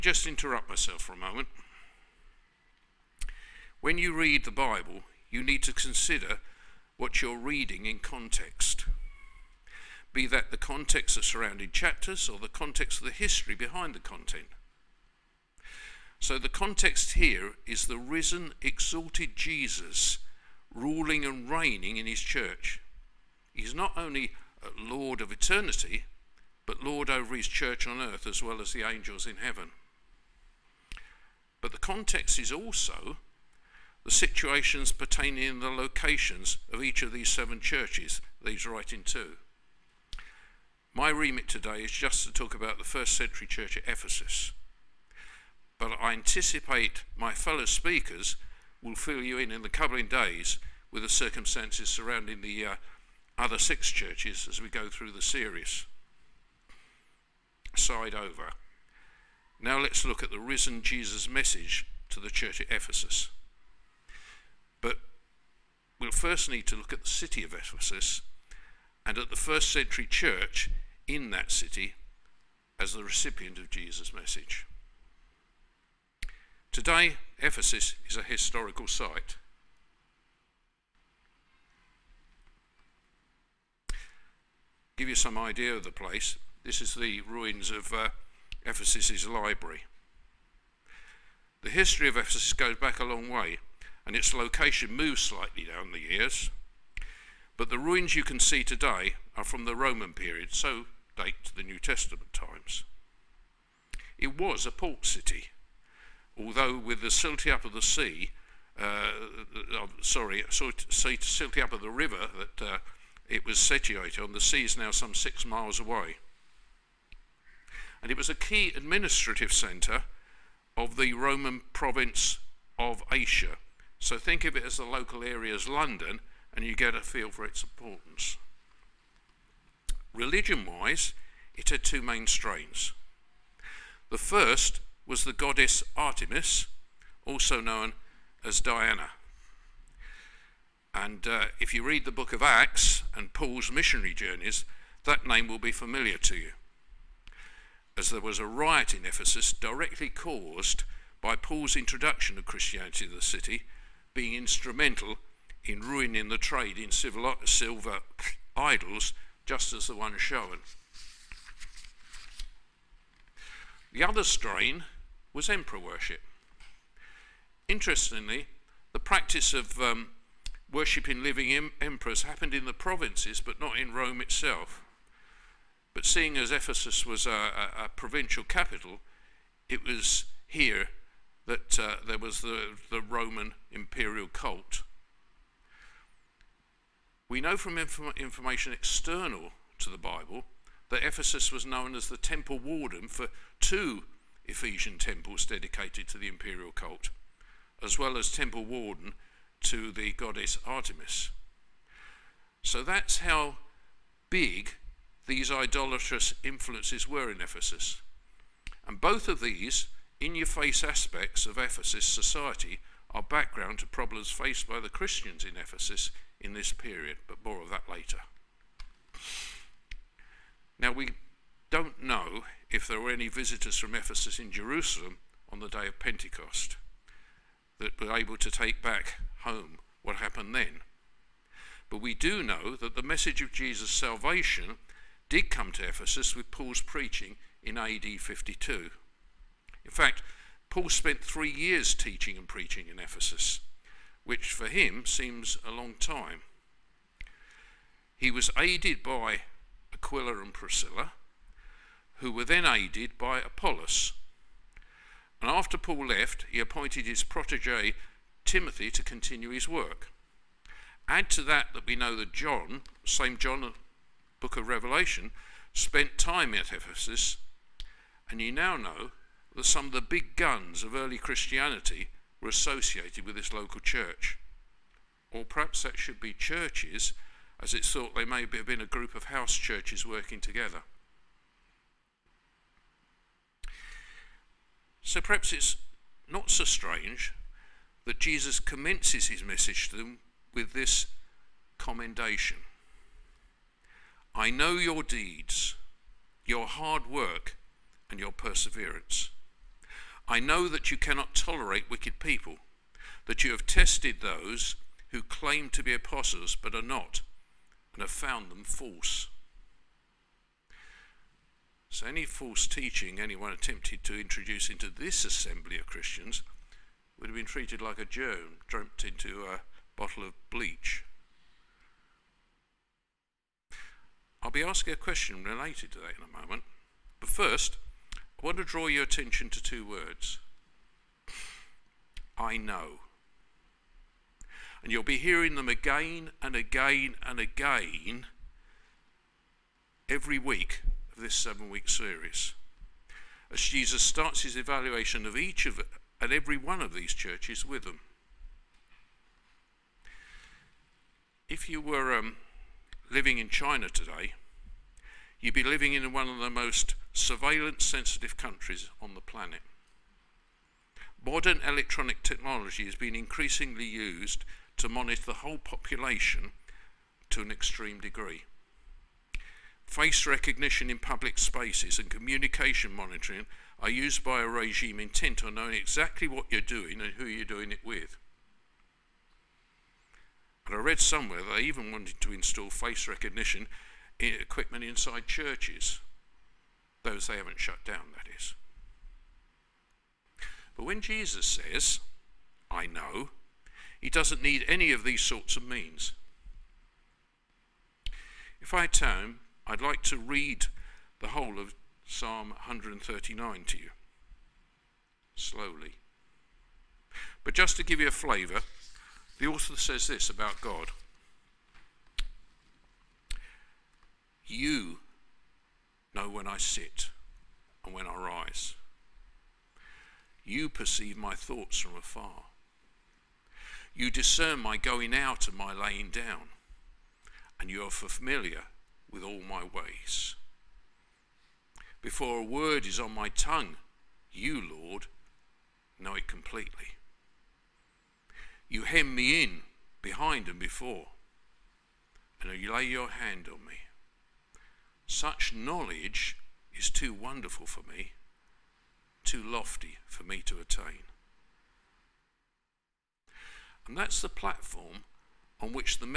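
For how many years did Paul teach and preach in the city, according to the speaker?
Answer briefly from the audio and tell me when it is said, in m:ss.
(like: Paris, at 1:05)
3, at 4:01.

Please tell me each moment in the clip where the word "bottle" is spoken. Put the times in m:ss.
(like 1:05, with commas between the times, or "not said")
5:19.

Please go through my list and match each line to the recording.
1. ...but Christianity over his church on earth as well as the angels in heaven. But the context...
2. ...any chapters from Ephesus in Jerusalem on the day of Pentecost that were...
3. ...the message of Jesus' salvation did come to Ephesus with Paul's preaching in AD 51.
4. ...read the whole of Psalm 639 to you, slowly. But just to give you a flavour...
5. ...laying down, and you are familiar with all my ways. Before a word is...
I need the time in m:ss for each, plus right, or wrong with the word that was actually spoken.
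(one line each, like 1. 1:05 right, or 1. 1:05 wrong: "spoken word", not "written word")
1. 0:26 wrong: "Lord", not "Christianity"
2. 3:43 wrong: "visitors", not "chapters"
3. 3:52 wrong: "52", not "51"
4. 6:40 wrong: "139", not "639"
5. 7:05 right.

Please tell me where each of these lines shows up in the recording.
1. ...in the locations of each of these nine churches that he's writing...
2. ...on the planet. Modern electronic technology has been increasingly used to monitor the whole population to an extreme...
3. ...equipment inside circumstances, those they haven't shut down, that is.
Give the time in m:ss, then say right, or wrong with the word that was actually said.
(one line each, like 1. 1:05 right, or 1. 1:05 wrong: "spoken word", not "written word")
1. 0:35 wrong: "seven", not "nine"
2. 5:59 right
3. 6:24 wrong: "churches", not "circumstances".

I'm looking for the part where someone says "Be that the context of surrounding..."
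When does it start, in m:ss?
0:10.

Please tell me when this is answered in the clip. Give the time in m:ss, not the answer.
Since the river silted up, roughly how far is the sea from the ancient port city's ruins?
1:55.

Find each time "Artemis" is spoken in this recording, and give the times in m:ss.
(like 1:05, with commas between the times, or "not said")
2:15, 3:20.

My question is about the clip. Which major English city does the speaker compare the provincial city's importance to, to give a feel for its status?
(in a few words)
London.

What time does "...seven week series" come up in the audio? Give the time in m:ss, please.
5:41.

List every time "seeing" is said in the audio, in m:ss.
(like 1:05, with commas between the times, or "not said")
2:56.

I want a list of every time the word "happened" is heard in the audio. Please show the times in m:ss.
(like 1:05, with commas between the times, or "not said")
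2:52, 3:50.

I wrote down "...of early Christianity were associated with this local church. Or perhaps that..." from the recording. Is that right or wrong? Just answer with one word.
right.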